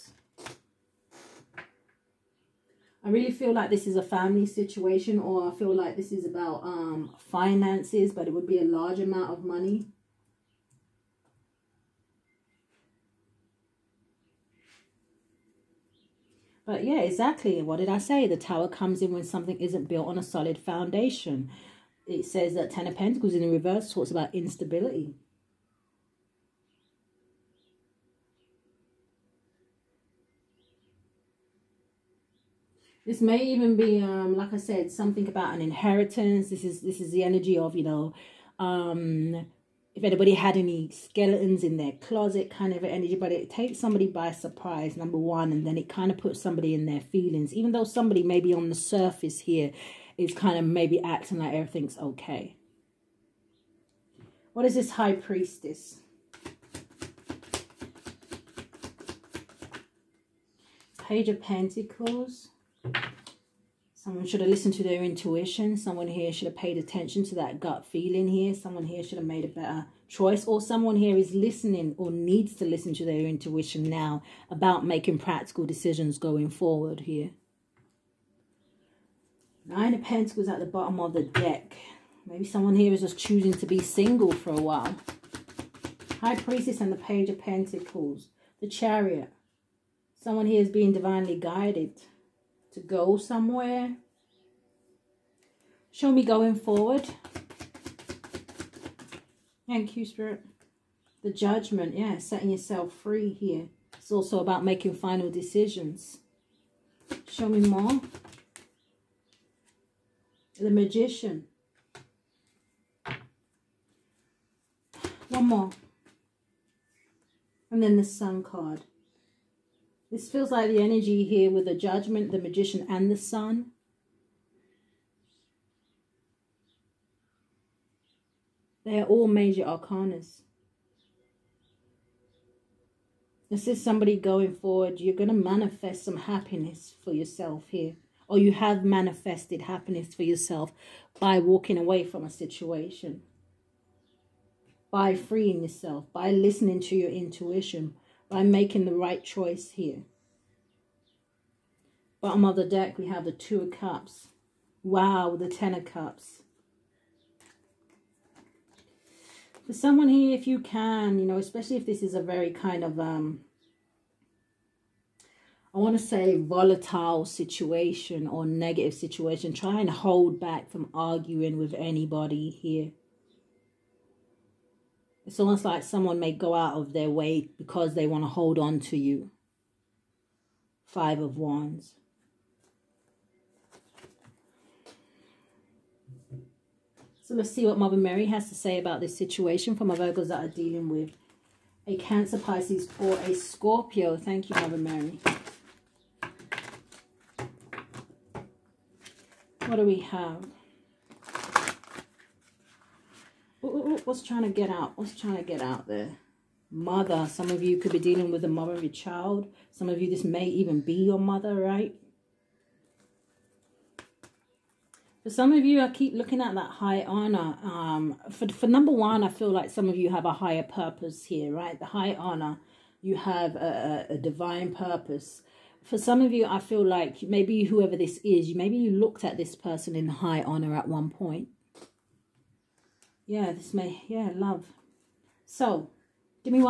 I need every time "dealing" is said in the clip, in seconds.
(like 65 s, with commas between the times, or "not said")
190 s, 207 s.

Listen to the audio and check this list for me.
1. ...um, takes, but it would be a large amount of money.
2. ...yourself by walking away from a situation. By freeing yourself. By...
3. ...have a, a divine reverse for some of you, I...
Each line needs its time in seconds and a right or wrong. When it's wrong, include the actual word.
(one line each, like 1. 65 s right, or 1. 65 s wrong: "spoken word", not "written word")
1. 6 s wrong: "finances", not "takes"
2. 140 s right
3. 223 s wrong: "purpose", not "reverse".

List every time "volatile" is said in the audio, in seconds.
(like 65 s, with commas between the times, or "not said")
166 s.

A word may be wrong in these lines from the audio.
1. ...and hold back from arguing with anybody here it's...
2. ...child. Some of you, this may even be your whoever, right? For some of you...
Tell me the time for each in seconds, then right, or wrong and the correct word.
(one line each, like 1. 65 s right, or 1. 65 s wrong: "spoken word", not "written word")
1. 169 s right
2. 208 s wrong: "mother", not "whoever".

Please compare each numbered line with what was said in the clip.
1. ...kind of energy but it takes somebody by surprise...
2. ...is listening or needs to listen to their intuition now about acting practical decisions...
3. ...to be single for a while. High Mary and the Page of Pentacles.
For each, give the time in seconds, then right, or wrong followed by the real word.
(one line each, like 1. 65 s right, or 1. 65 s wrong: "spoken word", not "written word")
1. 42 s right
2. 71 s wrong: "making", not "acting"
3. 83 s wrong: "Priestess", not "Mary".